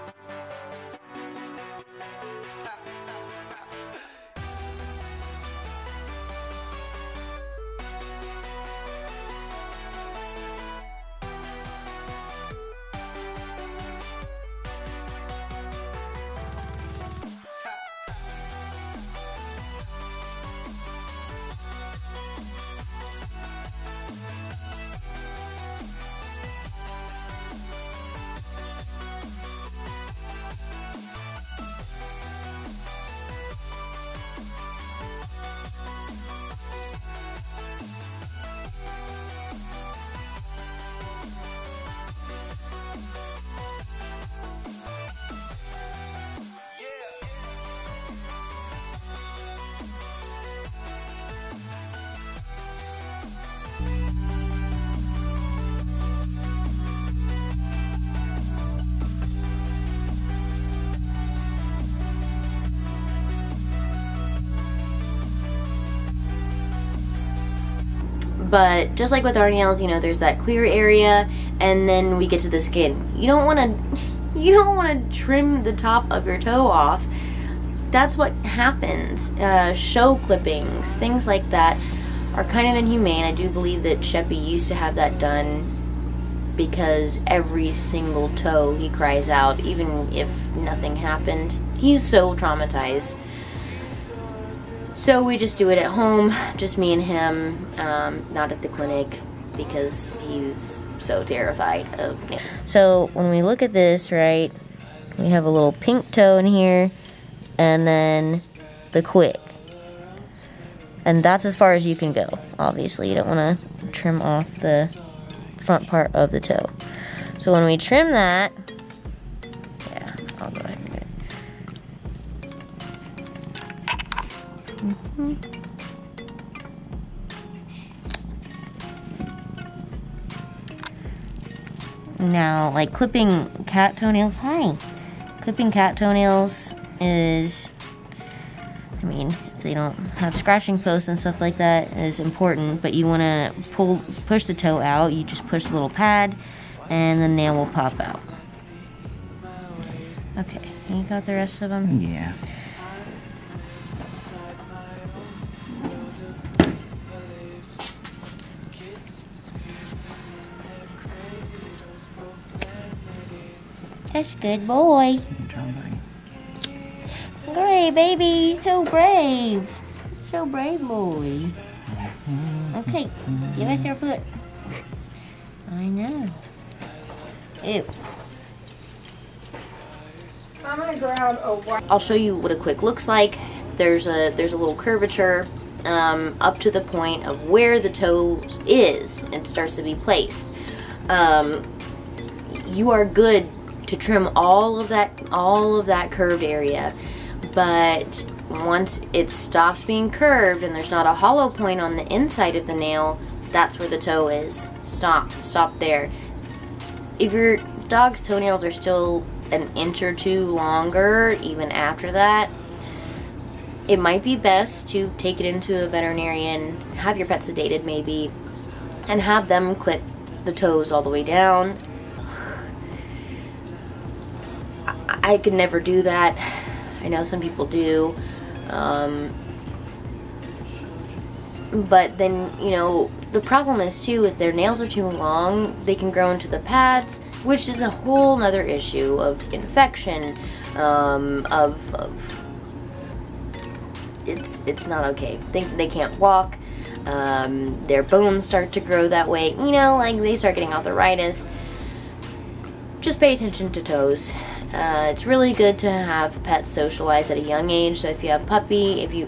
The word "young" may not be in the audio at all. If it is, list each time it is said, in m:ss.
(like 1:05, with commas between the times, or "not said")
4:17.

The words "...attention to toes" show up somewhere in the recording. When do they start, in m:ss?
4:13.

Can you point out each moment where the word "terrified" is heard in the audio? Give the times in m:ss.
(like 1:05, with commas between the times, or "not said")
1:41.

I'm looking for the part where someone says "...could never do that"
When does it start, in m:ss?
3:45.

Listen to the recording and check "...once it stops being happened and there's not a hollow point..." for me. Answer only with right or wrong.
wrong.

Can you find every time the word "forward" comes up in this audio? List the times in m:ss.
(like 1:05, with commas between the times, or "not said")
not said.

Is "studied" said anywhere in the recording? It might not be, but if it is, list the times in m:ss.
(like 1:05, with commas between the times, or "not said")
not said.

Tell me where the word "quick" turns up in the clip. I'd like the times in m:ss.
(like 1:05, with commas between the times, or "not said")
1:49, 3:02.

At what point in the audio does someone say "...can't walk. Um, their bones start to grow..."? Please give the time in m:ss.
4:05.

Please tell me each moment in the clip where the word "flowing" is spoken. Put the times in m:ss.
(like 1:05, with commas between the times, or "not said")
not said.